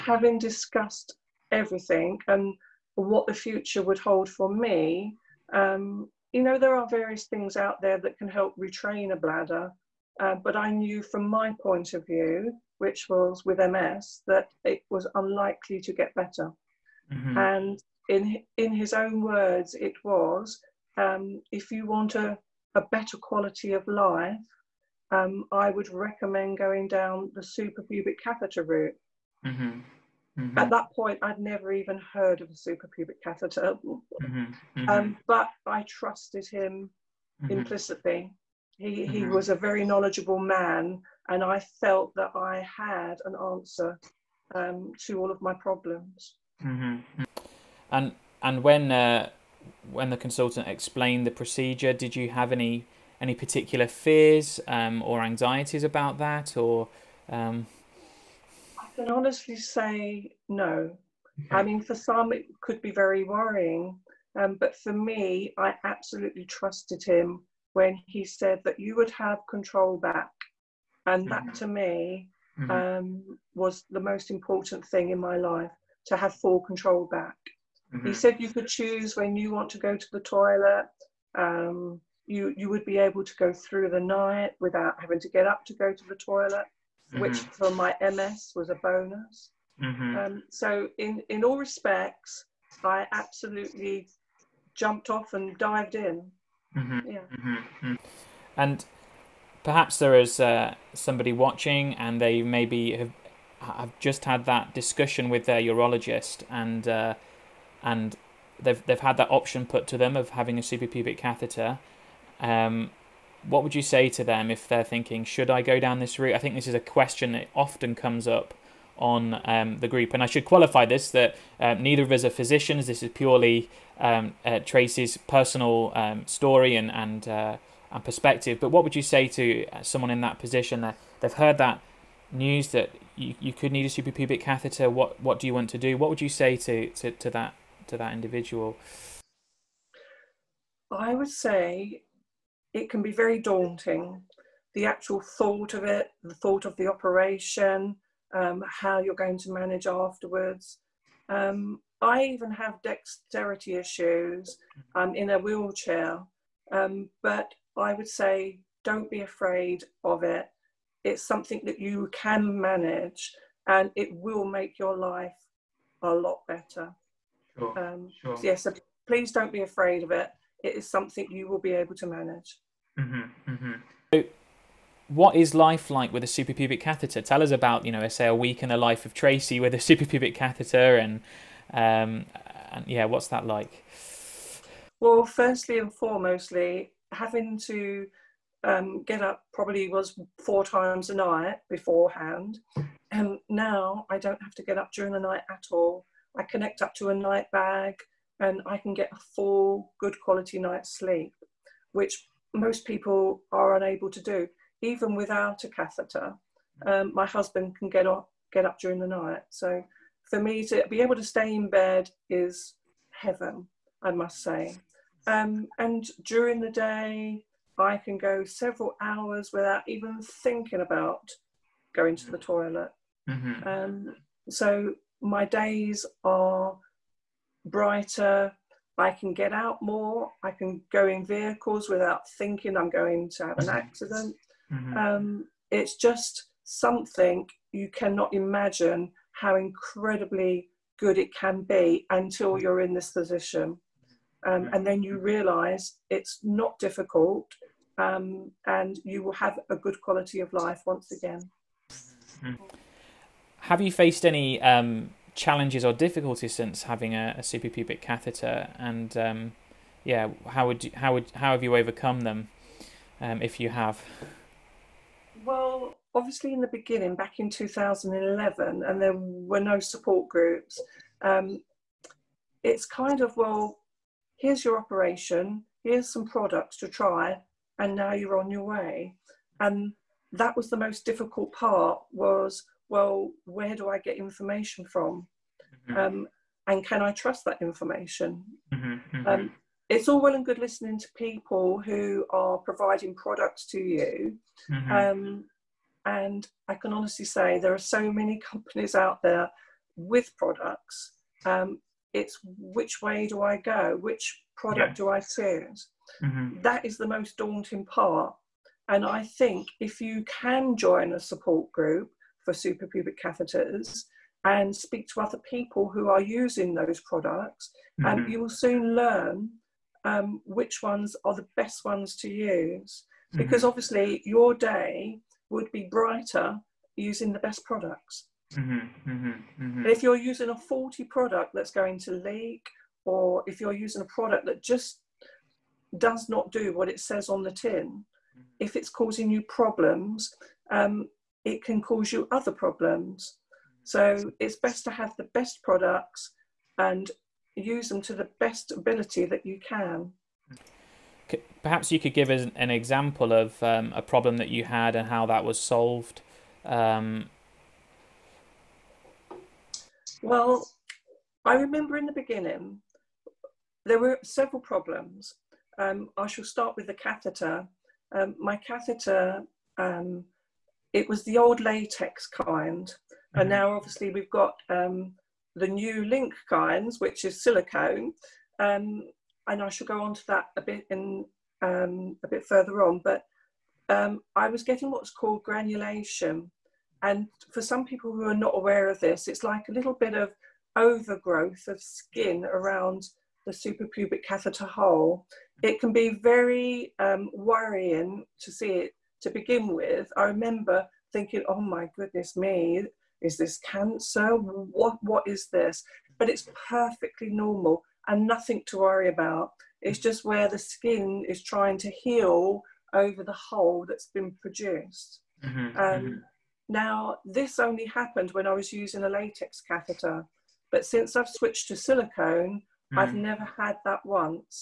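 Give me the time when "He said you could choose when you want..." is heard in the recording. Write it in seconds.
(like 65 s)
78 s.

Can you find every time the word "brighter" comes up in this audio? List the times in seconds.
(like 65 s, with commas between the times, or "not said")
227 s, 325 s.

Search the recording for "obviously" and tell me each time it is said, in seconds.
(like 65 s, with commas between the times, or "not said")
266 s, 323 s, 373 s.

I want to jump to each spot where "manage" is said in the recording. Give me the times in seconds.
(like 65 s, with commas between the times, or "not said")
149 s, 162 s, 172 s.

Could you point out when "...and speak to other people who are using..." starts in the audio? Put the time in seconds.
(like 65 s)
314 s.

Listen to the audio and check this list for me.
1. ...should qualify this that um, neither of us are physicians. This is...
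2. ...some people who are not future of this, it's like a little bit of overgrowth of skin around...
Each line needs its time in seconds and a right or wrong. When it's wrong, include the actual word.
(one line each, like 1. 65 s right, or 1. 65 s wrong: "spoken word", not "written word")
1. 120 s right
2. 387 s wrong: "aware", not "future".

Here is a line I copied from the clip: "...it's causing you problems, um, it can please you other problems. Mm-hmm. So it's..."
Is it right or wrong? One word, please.
wrong.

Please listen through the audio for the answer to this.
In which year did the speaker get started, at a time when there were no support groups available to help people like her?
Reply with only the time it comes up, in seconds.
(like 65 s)
267 s.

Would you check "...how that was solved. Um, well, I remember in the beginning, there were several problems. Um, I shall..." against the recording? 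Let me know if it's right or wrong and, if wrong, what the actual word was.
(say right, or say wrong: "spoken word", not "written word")
right.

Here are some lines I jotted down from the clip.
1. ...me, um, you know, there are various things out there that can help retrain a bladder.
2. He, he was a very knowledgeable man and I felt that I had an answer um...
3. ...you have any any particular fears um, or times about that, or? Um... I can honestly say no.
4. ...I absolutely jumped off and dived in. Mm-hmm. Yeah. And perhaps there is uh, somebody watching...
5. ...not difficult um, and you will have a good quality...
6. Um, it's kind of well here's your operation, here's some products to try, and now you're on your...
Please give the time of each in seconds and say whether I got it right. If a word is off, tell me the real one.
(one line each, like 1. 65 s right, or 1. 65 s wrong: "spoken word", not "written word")
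1. 4 s right
2. 38 s right
3. 52 s wrong: "anxieties", not "times"
4. 92 s right
5. 246 s right
6. 271 s right.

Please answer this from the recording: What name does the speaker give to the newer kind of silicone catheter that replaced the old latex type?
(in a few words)
LINC.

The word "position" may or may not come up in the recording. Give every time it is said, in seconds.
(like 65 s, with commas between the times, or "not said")
130 s, 243 s.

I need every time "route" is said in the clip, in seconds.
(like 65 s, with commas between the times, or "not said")
28 s, 116 s.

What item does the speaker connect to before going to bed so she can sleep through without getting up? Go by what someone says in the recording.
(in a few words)
a night bag.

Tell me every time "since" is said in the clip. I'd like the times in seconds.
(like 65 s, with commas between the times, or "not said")
256 s, 420 s.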